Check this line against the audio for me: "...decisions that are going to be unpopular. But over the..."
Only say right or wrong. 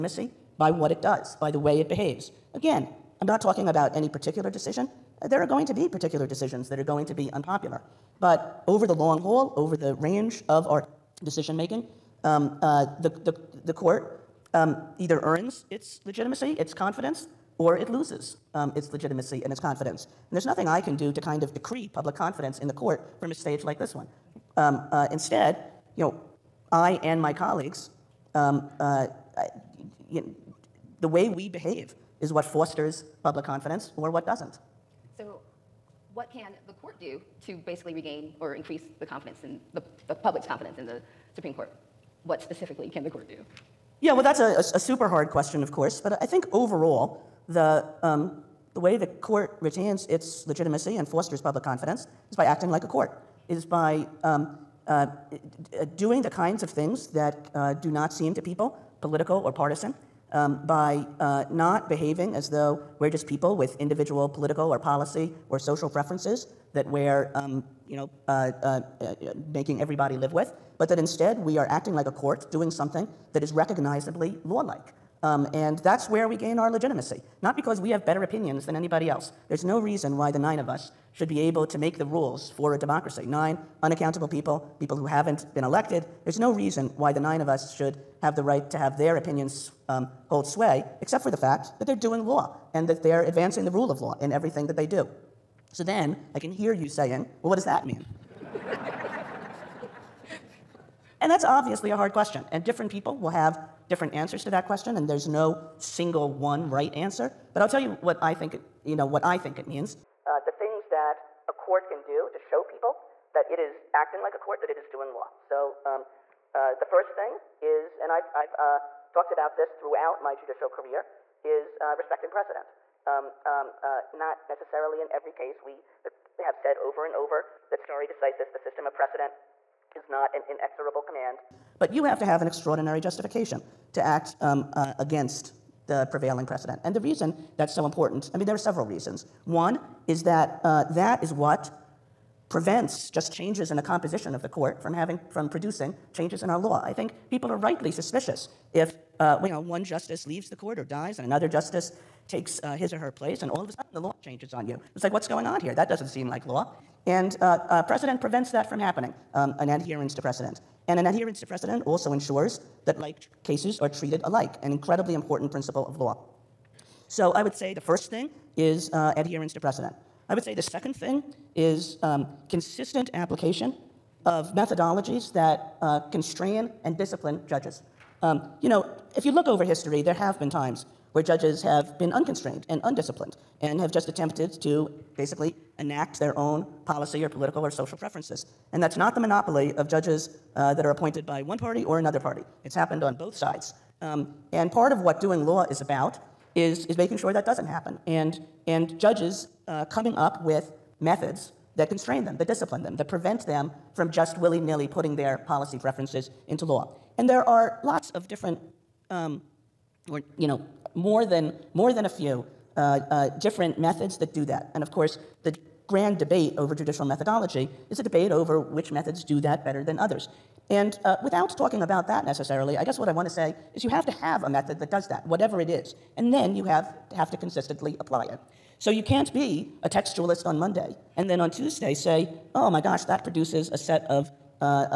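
right.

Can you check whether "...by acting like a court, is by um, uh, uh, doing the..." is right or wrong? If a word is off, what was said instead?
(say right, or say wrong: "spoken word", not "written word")
right.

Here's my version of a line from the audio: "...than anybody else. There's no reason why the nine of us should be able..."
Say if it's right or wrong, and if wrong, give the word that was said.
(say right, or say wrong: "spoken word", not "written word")
right.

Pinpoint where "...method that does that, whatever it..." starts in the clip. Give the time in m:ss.
3:44.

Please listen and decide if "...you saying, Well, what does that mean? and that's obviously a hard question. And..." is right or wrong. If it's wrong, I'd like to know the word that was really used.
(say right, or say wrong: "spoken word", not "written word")
right.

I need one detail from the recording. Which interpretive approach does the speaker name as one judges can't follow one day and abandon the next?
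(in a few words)
textualist.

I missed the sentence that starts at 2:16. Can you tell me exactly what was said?
And the reason that's so important, I mean, there are several reasons.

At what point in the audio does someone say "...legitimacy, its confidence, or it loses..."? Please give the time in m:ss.
0:16.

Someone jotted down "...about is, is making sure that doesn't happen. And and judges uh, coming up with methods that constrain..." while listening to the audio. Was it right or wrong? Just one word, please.
right.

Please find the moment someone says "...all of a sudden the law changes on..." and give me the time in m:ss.
2:33.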